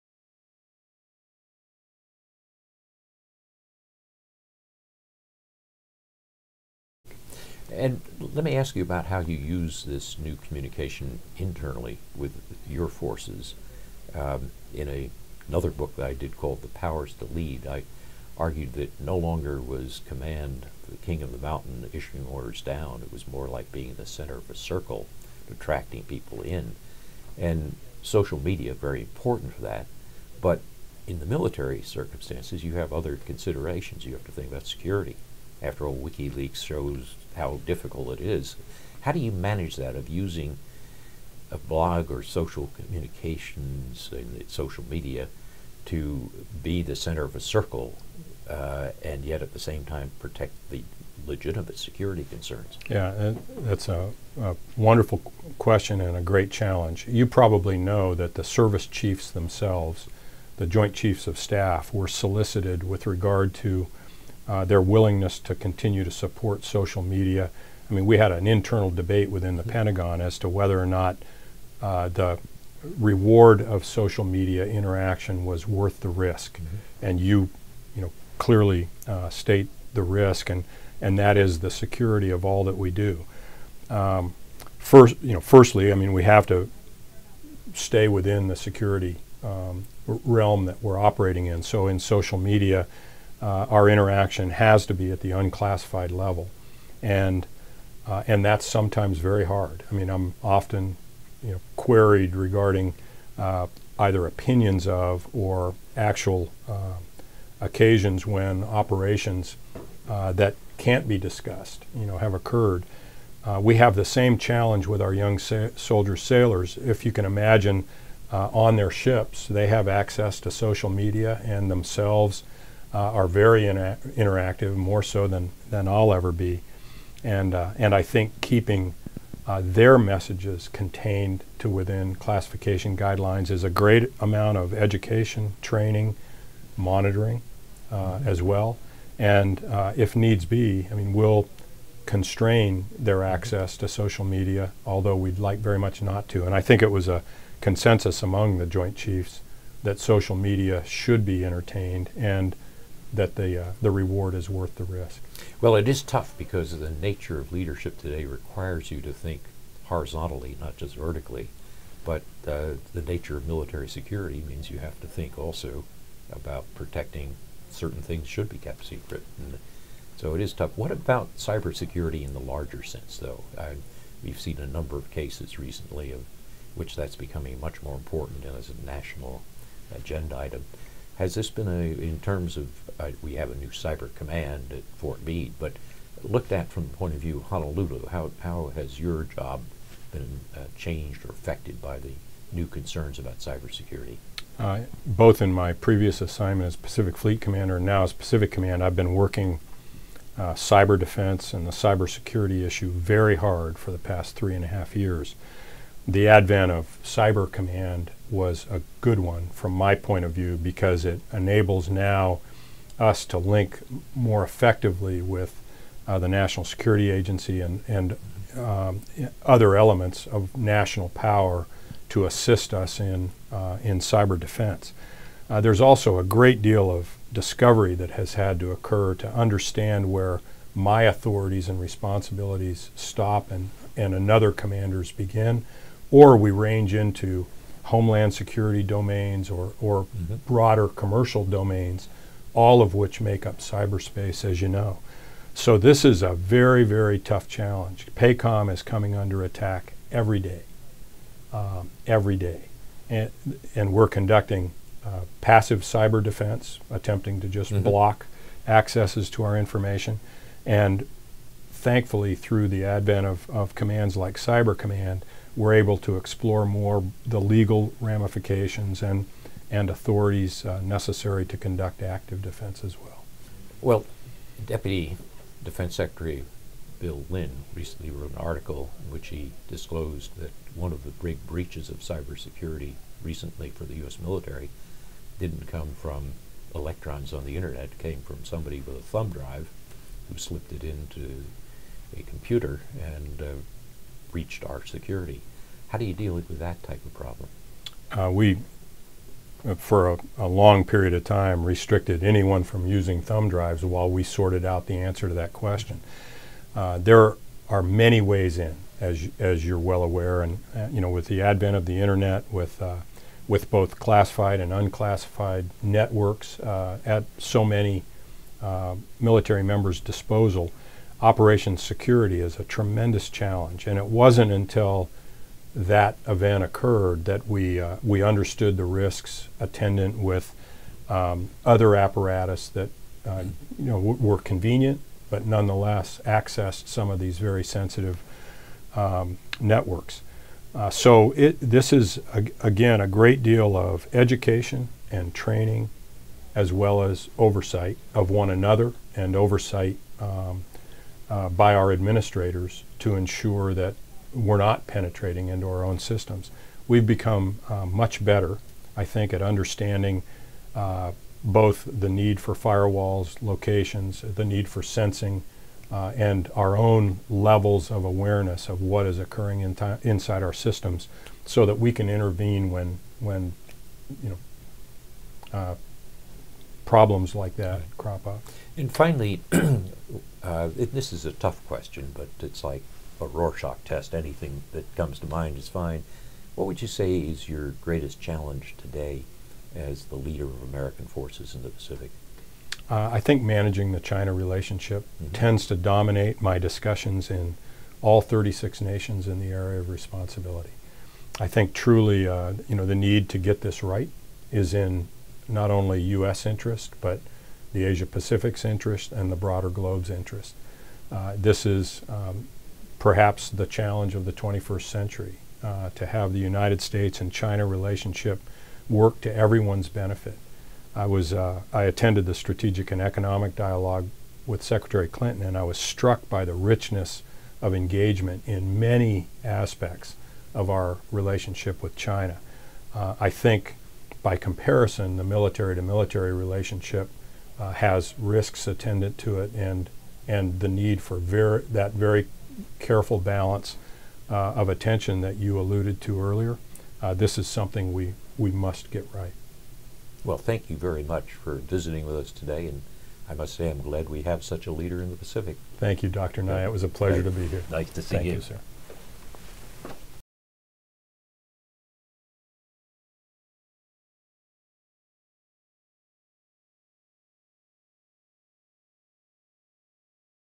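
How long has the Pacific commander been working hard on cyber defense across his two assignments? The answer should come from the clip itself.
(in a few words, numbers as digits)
three and a half years.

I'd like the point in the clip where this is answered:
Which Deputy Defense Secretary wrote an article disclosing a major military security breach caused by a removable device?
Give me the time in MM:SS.
04:36.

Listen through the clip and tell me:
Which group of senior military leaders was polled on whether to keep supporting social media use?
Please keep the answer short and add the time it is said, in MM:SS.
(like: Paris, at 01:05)
Joint Chiefs of Staff, at 01:00.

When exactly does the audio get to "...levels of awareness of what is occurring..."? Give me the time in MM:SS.
06:07.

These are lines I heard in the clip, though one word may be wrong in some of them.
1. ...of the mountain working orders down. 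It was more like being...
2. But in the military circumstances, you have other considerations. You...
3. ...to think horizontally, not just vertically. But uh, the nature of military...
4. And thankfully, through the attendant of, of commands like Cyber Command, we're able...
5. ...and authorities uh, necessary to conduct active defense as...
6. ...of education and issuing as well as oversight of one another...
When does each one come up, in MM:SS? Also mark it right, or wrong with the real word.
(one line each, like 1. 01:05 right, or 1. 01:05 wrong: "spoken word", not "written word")
1. 00:21 wrong: "issuing", not "working"
2. 00:30 right
3. 02:39 right
4. 04:20 wrong: "advent", not "attendant"
5. 04:29 right
6. 05:43 wrong: "training", not "issuing".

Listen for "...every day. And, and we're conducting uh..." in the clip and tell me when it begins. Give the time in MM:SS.
04:12.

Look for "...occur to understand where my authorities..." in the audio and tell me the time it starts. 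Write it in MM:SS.
03:48.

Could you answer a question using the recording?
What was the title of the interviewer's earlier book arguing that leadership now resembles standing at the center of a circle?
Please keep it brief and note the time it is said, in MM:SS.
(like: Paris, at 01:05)
The Powers to Lead, at 00:16.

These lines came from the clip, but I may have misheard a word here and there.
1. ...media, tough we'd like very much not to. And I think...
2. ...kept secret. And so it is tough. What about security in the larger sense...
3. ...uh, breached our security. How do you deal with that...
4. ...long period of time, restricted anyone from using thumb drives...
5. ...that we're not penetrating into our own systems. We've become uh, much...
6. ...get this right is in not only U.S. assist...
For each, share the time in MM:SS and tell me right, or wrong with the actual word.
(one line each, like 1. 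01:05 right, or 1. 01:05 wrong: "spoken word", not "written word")
1. 02:24 wrong: "although", not "tough"
2. 02:48 wrong: "cybersecurity", not "security"
3. 04:53 right
4. 05:00 right
5. 05:53 right
6. 06:43 wrong: "interest", not "assist".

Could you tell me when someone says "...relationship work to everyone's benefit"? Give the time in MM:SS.
06:57.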